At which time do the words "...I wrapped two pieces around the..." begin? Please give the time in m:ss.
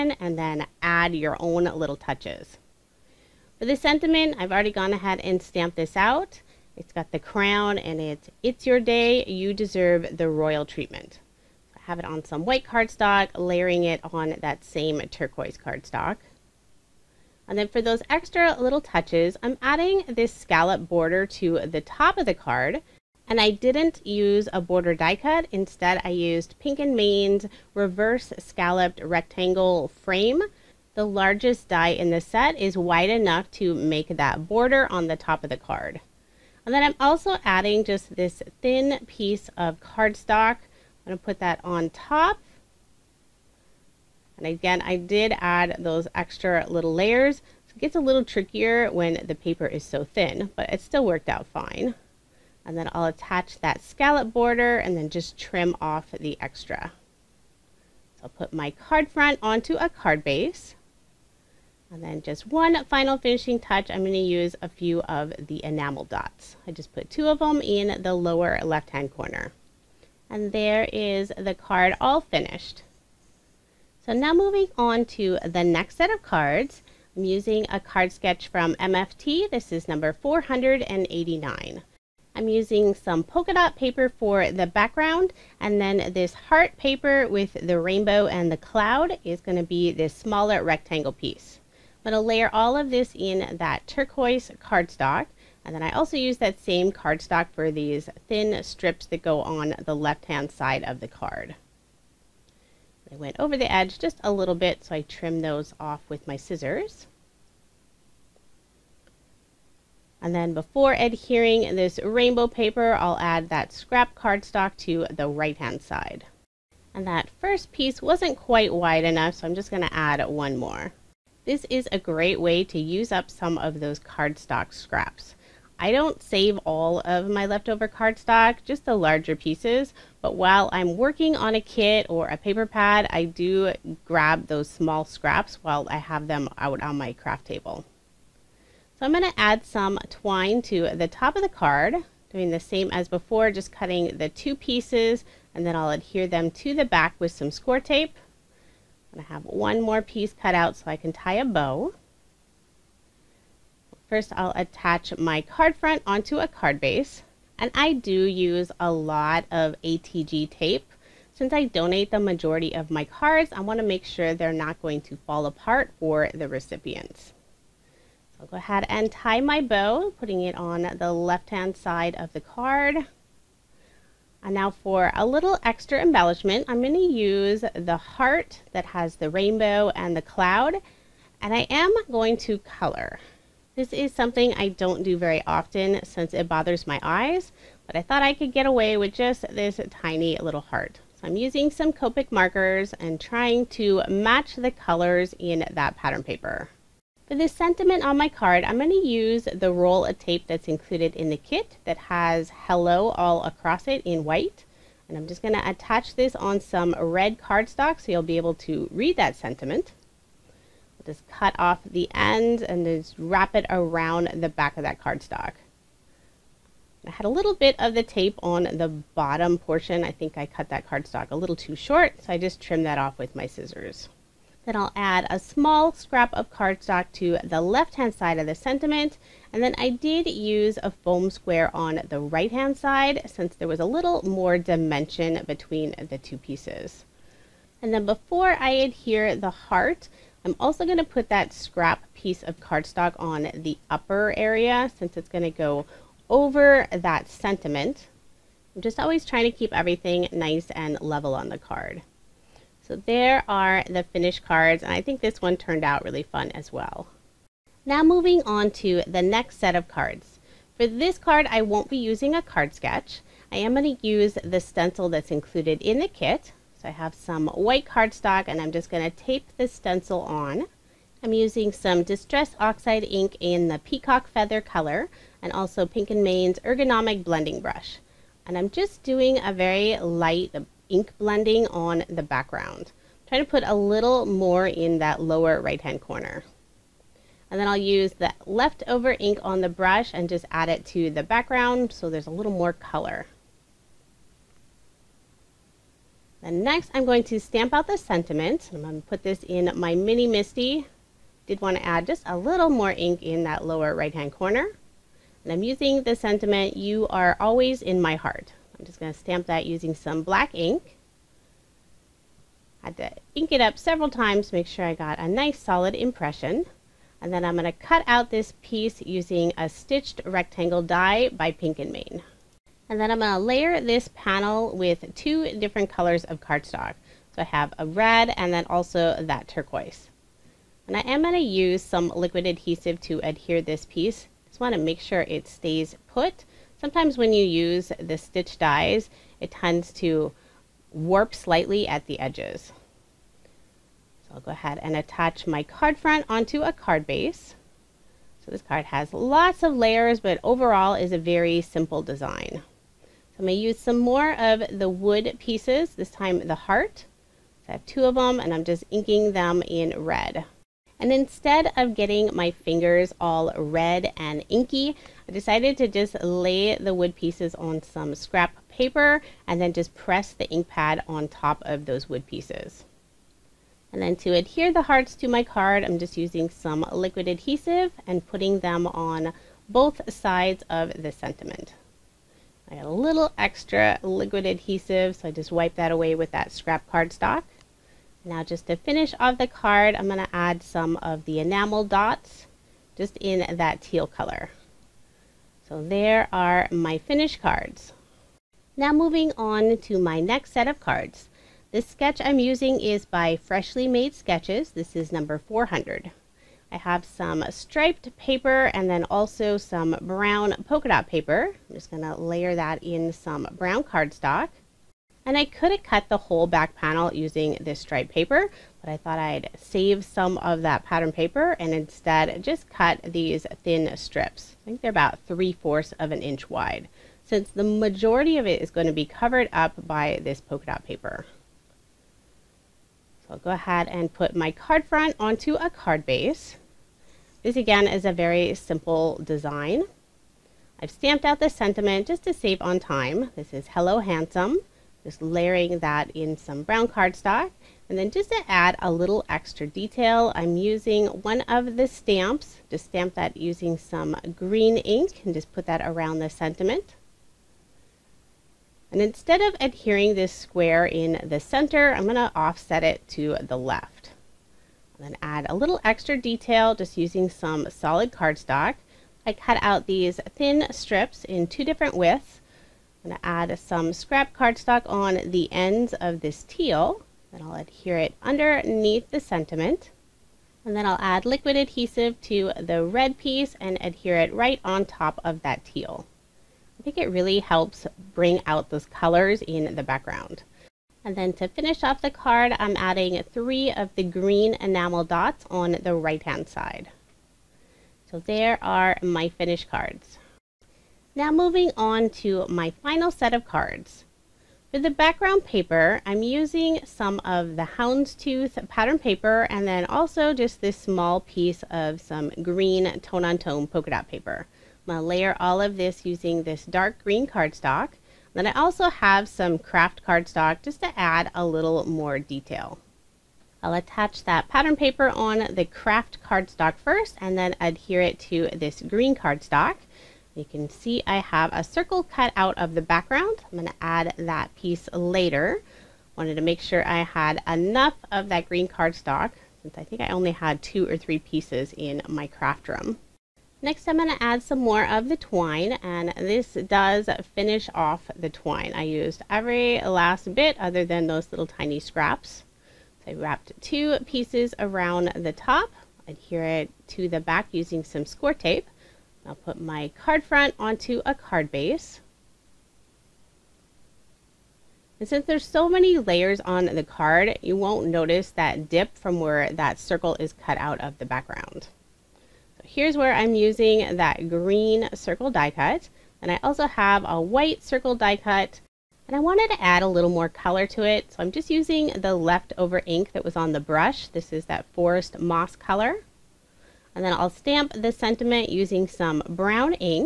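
9:13.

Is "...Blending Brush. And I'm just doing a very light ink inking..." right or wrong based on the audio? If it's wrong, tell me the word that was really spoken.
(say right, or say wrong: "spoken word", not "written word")
wrong: "blending", not "inking".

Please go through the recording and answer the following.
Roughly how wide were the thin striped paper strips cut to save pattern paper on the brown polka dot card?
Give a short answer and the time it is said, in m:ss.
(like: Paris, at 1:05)
3/4 inch, at 7:05.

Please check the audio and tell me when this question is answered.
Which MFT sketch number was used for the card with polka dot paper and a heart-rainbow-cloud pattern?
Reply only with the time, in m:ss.
1:20.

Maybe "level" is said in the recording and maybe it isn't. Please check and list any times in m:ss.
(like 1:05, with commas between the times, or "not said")
4:11.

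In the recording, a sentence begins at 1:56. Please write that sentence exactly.
And that first piece wasn't quite wide enough, so I'm just gonna add one more.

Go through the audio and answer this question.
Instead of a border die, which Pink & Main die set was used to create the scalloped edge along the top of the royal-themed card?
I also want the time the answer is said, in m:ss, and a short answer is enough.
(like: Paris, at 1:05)
Reverse Scalloped Rectangle Frame, at 0:27.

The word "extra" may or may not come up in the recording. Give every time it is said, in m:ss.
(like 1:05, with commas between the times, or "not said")
0:18, 0:46, 0:56, 2:55, 6:23, 7:29, 7:45.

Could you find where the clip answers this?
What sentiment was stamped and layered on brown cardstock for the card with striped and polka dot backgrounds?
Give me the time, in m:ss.
7:23.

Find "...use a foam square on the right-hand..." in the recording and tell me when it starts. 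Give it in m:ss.
3:50.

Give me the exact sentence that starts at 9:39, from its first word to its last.
And I wanted to add a little more color to it.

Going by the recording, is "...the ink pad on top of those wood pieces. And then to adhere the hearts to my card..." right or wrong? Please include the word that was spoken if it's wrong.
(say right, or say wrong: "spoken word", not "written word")
right.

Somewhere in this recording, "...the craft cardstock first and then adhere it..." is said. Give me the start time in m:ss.
8:45.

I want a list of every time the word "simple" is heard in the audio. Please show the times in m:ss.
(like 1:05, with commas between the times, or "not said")
5:51, 7:18.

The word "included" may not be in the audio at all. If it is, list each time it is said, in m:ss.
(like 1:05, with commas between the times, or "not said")
3:20, 4:25.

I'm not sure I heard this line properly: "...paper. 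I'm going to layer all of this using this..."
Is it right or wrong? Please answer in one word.
right.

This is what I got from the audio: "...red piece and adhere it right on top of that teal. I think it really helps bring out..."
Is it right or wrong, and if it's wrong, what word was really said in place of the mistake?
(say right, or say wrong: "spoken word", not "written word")
right.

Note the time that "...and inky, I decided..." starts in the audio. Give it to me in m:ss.
6:04.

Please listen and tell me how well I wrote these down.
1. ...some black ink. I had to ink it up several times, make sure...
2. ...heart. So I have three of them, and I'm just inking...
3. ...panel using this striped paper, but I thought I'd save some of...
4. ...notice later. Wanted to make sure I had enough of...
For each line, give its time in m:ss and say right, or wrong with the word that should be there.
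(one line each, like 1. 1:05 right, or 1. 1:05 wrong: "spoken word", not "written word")
1. 5:09 right
2. 5:56 wrong: "two", not "three"
3. 6:56 right
4. 8:54 wrong: "piece", not "notice".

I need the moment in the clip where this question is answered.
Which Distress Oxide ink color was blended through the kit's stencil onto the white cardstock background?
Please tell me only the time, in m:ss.
4:33.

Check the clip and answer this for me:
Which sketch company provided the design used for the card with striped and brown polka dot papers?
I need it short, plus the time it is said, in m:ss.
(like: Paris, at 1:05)
Freshly Made Sketches, at 6:43.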